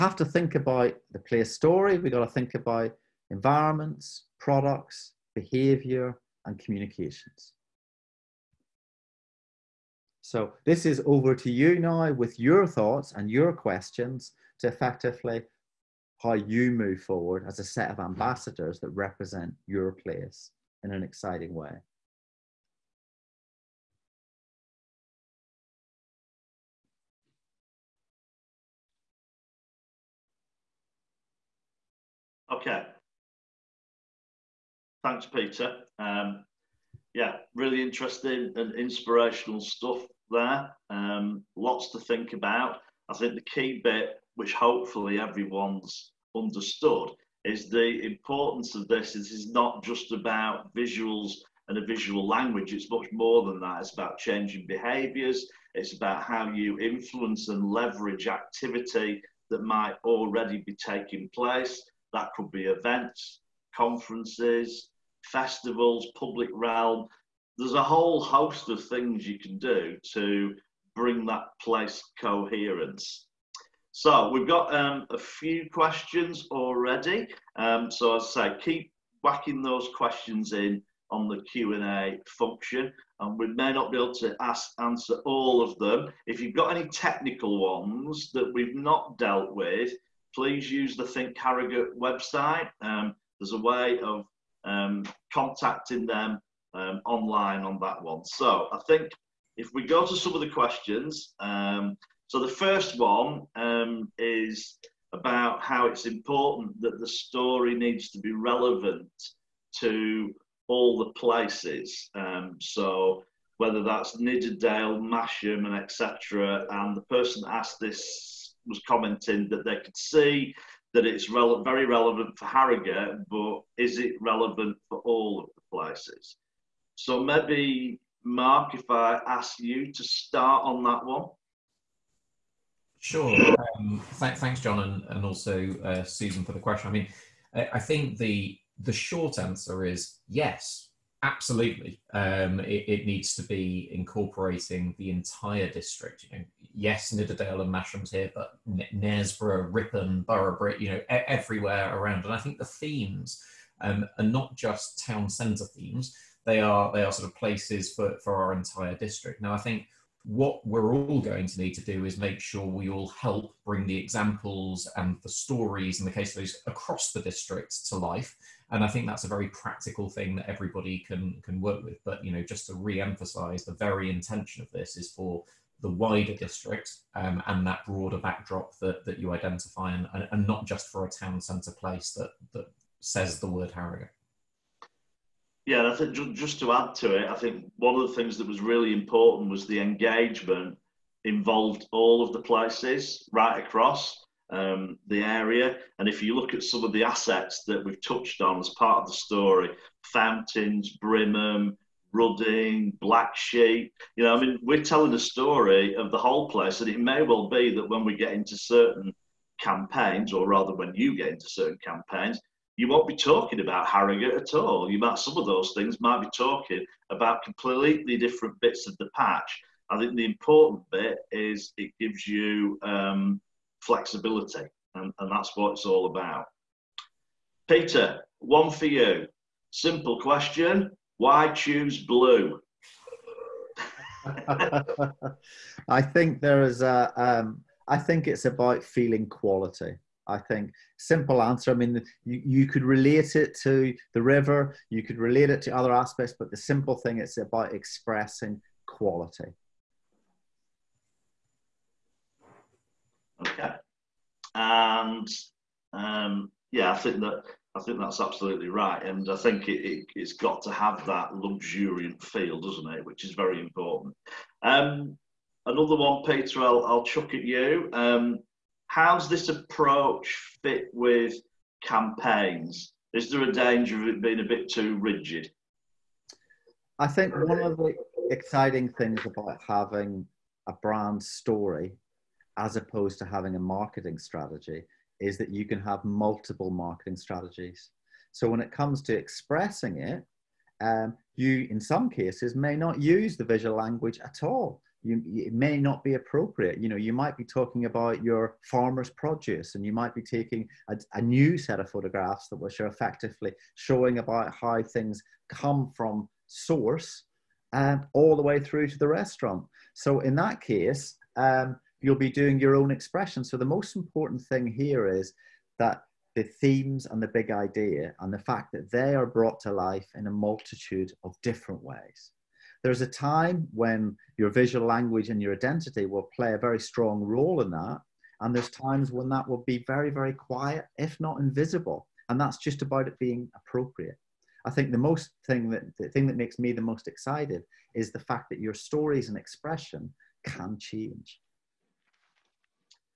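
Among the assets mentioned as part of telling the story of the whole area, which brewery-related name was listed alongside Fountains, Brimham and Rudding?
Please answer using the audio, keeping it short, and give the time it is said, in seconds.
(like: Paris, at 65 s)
Black Sheep, at 203 s.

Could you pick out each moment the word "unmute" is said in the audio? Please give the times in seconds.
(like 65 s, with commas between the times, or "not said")
not said.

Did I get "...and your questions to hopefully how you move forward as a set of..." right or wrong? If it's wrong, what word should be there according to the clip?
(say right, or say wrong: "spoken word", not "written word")
wrong: "effectively", not "hopefully".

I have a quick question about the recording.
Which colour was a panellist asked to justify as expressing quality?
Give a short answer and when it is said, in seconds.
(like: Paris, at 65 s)
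Blue, at 232 s.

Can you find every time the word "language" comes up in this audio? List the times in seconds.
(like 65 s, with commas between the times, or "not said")
52 s, 293 s, 324 s.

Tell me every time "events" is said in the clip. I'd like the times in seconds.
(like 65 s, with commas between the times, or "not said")
62 s.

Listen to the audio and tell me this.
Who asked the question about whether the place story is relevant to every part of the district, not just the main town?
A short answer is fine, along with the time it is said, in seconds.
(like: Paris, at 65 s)
Susan, at 136 s.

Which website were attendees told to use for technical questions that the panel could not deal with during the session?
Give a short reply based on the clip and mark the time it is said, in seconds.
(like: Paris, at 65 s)
Think Harrogate website, at 91 s.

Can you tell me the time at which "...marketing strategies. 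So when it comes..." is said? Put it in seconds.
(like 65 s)
286 s.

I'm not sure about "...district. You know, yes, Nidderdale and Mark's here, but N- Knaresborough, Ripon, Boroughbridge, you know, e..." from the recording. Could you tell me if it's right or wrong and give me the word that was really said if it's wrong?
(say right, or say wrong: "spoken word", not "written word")
wrong: "Masham", not "Mark".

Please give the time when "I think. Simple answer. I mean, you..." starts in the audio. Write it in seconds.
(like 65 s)
240 s.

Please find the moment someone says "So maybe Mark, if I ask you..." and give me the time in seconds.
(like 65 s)
126 s.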